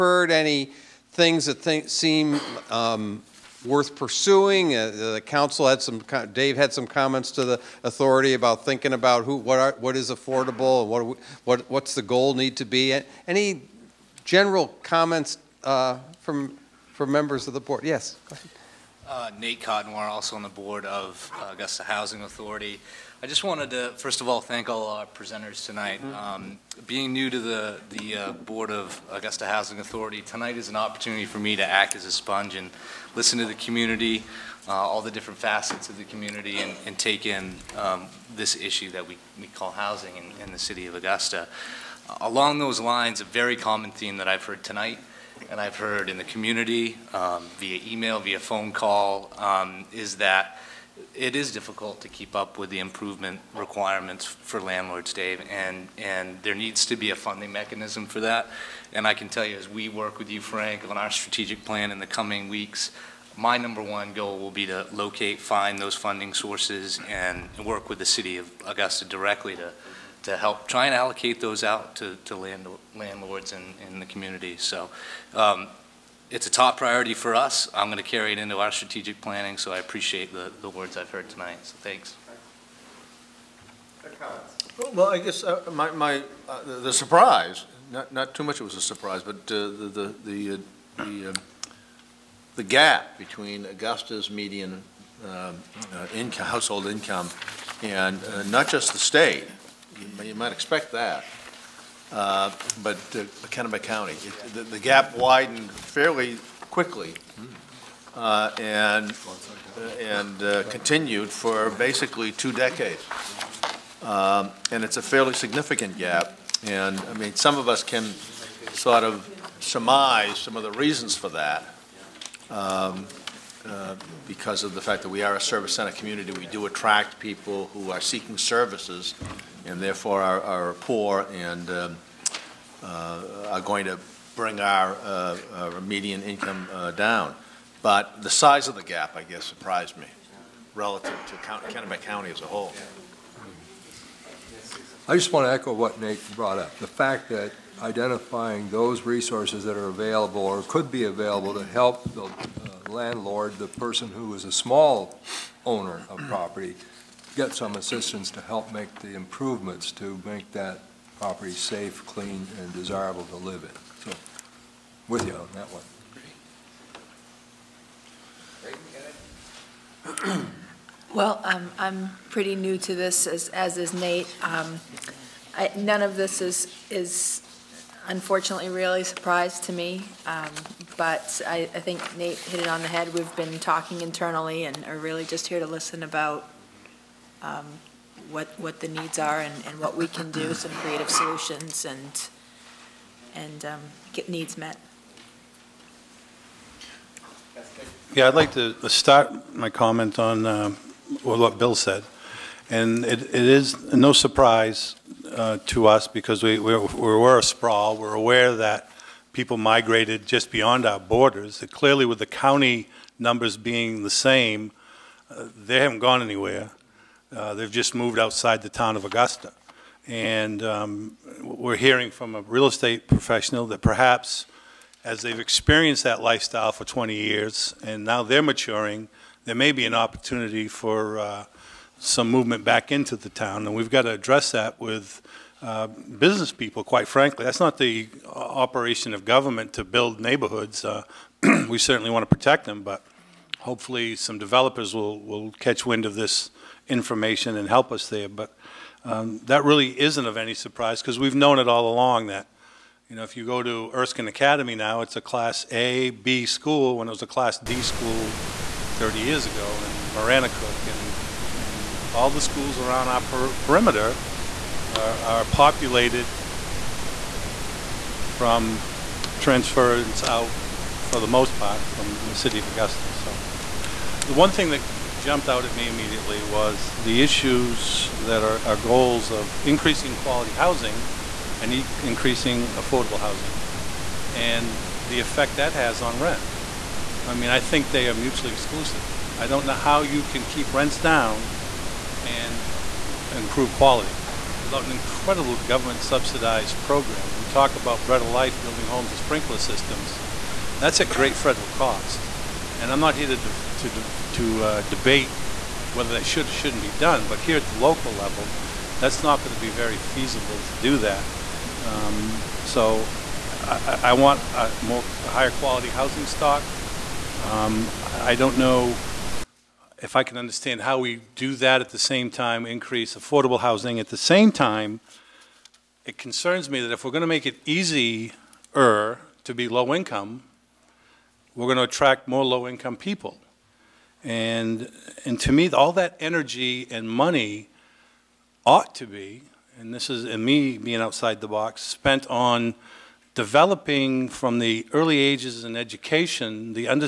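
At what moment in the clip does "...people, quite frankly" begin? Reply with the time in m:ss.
3:56.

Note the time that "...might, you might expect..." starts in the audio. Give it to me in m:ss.
1:40.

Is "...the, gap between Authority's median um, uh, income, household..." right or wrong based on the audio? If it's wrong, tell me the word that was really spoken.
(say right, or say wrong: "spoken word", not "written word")
wrong: "Augusta", not "Authority".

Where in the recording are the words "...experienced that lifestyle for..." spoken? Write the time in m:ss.
3:45.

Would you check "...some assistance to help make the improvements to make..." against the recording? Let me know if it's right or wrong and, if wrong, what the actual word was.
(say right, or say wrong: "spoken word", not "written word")
right.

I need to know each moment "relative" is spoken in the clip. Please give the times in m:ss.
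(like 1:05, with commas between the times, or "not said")
2:20.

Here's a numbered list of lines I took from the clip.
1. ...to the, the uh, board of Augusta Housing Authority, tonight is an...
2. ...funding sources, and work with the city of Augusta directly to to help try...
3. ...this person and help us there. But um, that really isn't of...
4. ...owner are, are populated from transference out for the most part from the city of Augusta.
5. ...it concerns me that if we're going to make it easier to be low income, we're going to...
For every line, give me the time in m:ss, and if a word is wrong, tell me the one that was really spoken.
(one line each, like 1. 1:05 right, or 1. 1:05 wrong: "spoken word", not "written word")
1. 0:27 right
2. 1:05 right
3. 4:06 wrong: "information", not "person"
4. 4:23 wrong: "perimeter", not "owner"
5. 5:26 right.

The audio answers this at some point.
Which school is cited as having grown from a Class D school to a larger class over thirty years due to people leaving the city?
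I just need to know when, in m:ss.
4:13.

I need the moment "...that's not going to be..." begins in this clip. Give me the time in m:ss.
5:08.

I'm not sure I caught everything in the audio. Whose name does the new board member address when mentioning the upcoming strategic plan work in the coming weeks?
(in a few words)
Frank.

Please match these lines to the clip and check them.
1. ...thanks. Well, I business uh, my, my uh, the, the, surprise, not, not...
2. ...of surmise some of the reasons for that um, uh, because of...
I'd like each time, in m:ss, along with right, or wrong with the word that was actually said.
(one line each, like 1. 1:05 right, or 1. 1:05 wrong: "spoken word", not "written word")
1. 1:21 wrong: "guess", not "business"
2. 1:59 right.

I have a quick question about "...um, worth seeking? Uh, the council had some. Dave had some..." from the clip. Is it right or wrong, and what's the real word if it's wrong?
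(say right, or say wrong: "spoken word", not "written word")
wrong: "pursuing", not "seeking".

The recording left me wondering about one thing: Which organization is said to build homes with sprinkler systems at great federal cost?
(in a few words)
Bread of Life.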